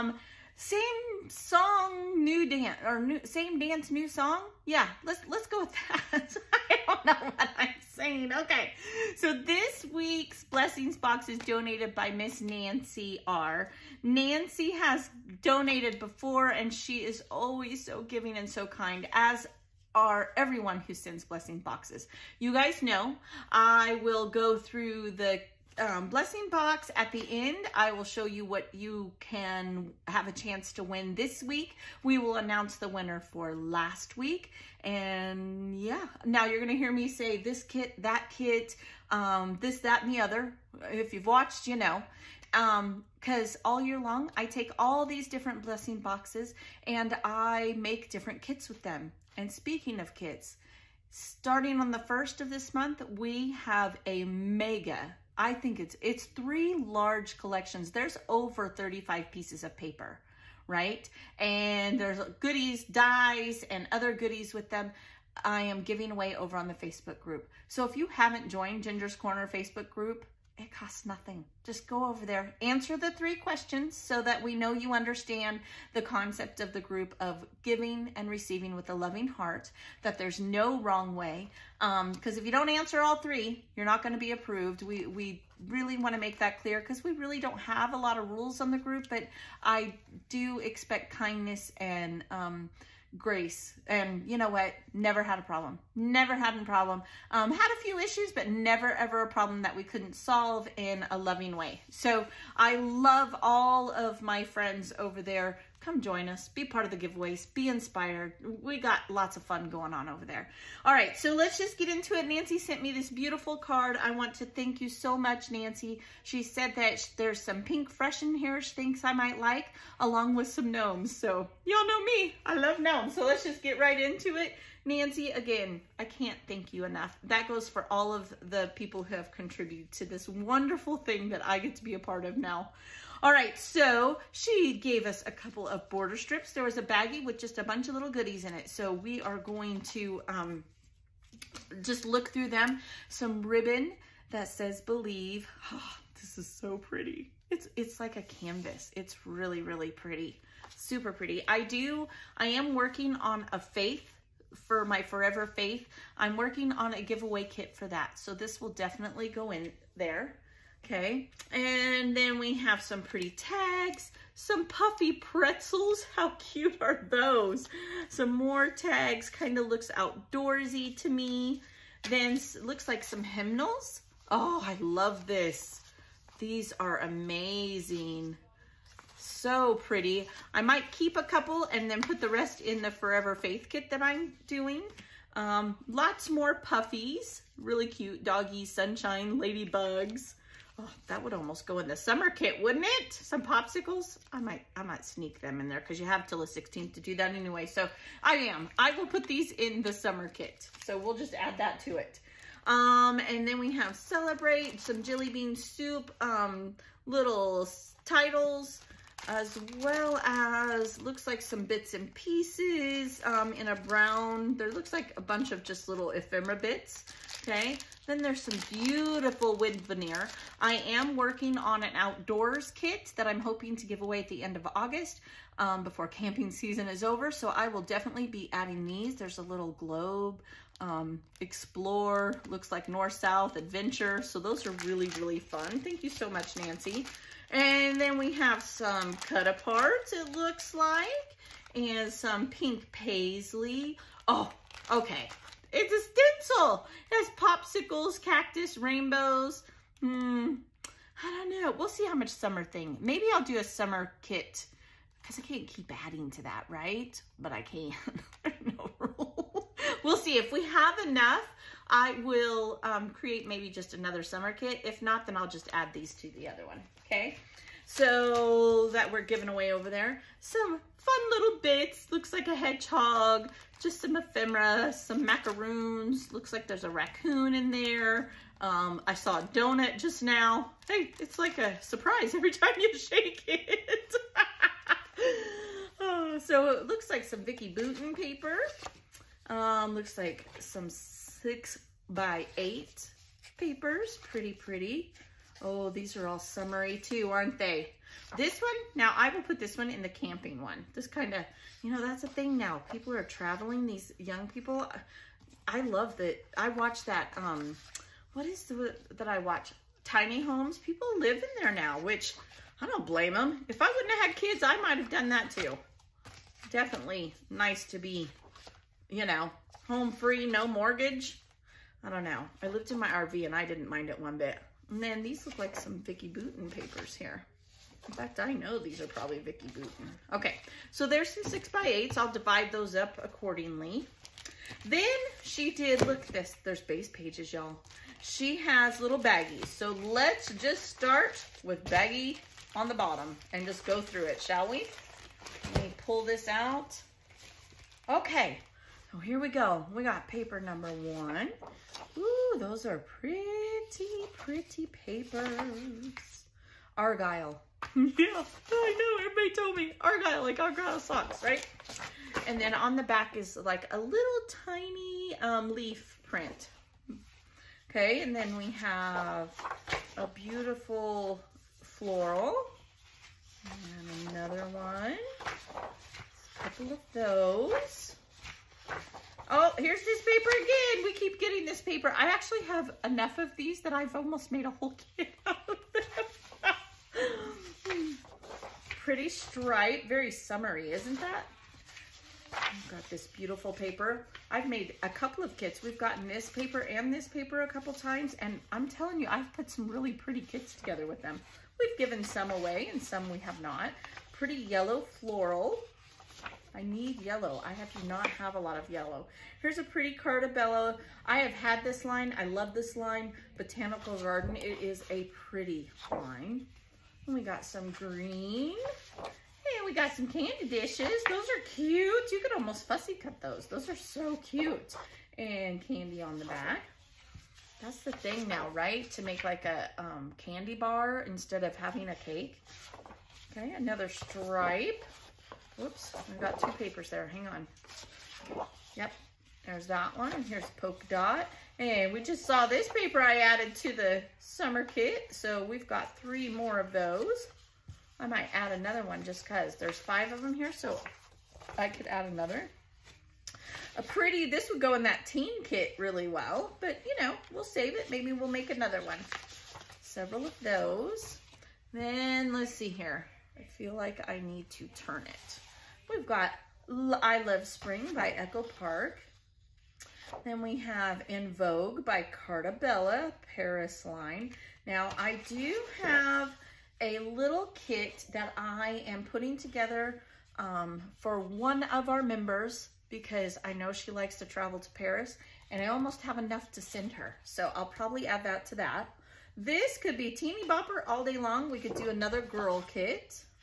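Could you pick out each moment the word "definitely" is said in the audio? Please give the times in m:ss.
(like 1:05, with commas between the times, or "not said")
2:38, 3:47, 5:16.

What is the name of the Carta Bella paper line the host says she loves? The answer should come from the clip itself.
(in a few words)
Botanical Garden.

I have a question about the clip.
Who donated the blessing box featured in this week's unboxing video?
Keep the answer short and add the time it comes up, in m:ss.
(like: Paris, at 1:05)
Nancy R., at 0:12.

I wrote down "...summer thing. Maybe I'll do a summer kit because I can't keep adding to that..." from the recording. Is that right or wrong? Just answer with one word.
right.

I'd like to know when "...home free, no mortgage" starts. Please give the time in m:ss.
5:19.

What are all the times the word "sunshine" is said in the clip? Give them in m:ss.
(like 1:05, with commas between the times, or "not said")
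3:08.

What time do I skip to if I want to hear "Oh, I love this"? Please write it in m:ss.
2:54.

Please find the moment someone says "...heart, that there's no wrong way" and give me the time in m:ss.
1:19.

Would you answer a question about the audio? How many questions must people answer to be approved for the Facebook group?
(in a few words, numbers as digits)
3.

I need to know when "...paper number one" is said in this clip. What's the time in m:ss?
5:50.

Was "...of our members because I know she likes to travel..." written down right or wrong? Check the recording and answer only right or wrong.
right.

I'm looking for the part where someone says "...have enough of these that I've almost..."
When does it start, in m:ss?
6:22.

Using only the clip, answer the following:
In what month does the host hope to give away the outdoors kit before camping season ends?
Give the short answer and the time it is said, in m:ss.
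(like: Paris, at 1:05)
August, at 3:44.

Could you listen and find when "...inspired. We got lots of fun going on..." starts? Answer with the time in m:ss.
1:47.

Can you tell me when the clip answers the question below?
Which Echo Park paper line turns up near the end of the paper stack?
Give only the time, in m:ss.
7:47.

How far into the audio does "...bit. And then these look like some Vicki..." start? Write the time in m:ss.
5:24.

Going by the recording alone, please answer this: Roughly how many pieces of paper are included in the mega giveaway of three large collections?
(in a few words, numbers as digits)
over 35.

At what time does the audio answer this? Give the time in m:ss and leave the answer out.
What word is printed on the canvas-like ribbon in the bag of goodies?
2:24.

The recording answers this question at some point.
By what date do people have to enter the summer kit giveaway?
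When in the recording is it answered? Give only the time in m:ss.
3:16.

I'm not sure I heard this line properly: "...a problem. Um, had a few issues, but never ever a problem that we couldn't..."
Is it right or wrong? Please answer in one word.
right.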